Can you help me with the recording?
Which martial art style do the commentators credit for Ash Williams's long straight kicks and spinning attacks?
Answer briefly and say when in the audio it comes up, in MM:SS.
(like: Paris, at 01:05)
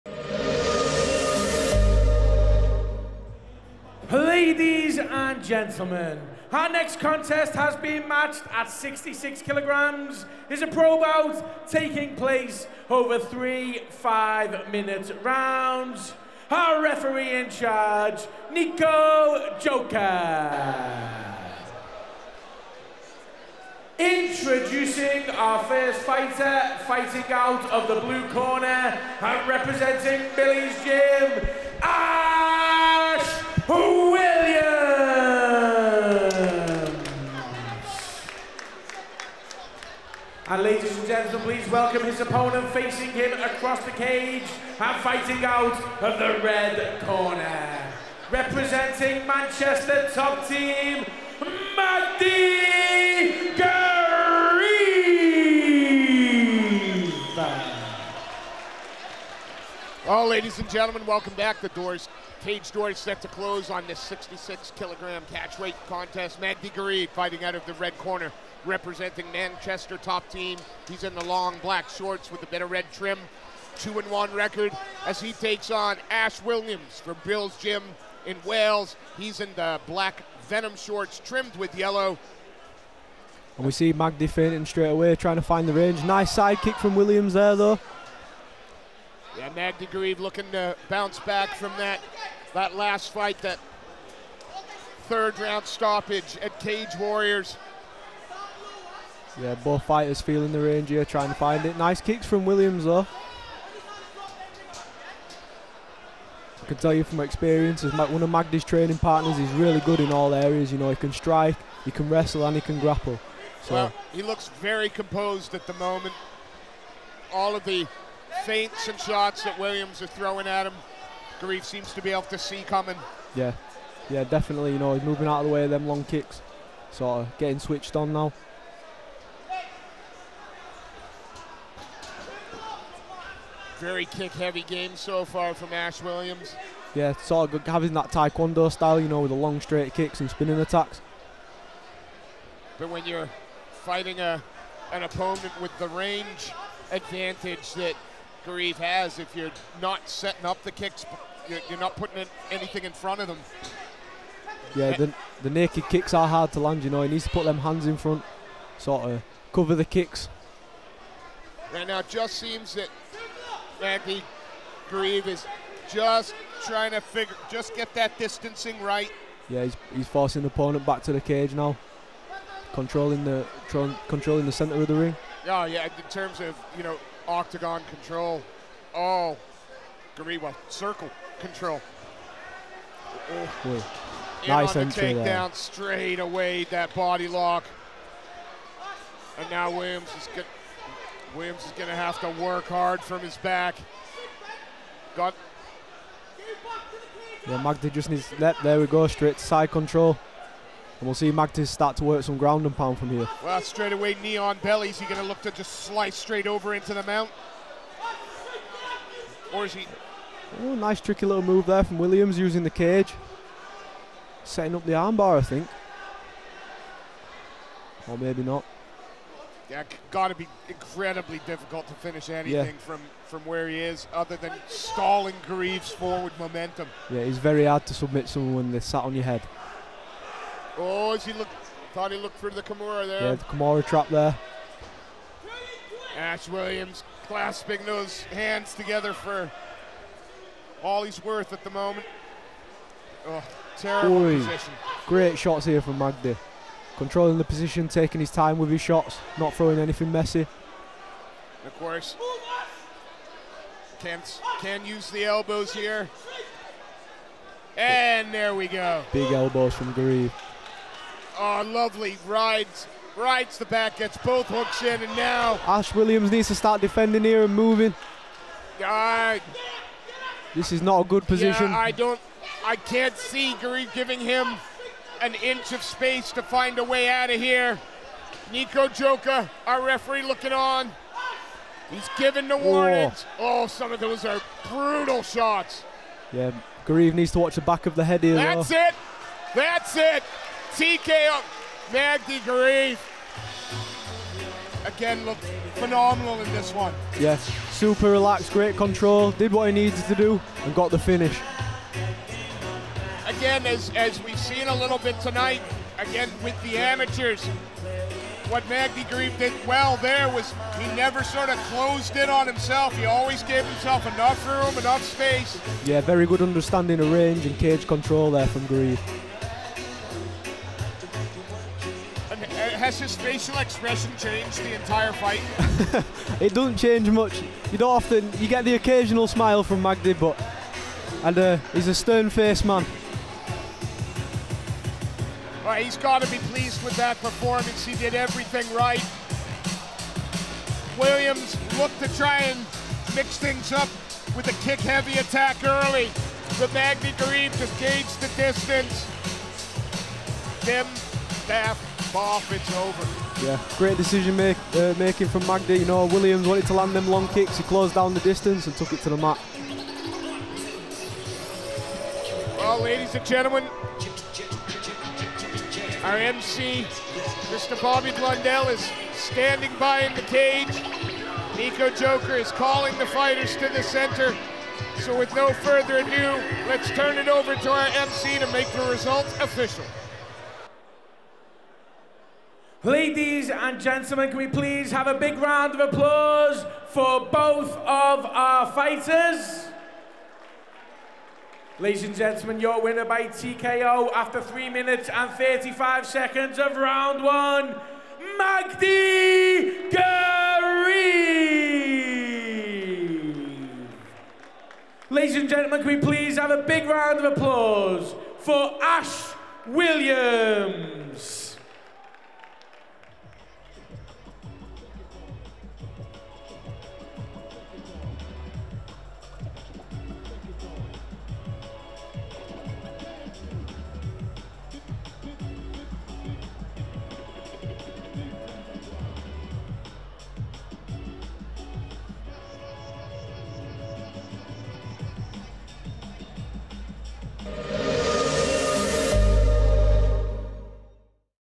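Taekwondo, at 02:18.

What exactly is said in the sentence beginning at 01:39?
Yeah, both fighters feeling the range here, trying to find it.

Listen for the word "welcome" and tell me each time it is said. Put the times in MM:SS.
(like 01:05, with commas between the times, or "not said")
00:41, 01:01.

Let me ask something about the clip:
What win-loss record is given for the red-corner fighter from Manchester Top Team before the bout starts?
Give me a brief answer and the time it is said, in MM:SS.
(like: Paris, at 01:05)
2 and 1, at 01:13.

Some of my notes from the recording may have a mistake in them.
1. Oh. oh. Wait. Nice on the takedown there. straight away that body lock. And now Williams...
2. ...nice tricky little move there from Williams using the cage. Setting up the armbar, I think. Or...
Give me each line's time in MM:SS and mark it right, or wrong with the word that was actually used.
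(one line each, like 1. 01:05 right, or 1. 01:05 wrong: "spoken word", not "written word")
1. 03:03 right
2. 03:30 right.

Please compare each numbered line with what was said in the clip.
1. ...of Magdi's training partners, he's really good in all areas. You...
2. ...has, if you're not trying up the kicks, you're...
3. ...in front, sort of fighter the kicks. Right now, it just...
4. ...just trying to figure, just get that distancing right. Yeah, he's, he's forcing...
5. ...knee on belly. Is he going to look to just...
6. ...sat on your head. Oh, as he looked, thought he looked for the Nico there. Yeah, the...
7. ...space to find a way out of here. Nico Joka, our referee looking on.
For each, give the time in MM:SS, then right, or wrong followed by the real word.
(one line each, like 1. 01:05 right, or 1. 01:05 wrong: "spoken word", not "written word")
1. 01:48 right
2. 02:28 wrong: "setting", not "trying"
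3. 02:37 wrong: "cover", not "fighter"
4. 02:45 right
5. 03:24 right
6. 03:48 wrong: "Kimura", not "Nico"
7. 04:35 right.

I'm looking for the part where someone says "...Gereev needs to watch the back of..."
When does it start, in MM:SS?
04:46.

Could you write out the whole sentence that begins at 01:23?
And we see Magdi fainting straight away, trying to find the range.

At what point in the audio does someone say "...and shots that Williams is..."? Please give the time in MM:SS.
01:58.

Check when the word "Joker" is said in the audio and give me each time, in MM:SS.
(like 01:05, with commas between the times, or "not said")
00:19, 06:11.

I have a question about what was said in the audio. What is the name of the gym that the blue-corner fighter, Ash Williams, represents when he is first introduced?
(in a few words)
Billy's Gym.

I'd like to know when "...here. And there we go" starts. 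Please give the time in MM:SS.
04:15.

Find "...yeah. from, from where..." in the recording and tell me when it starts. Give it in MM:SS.
03:42.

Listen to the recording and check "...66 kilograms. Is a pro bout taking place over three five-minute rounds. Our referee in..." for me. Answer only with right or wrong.
right.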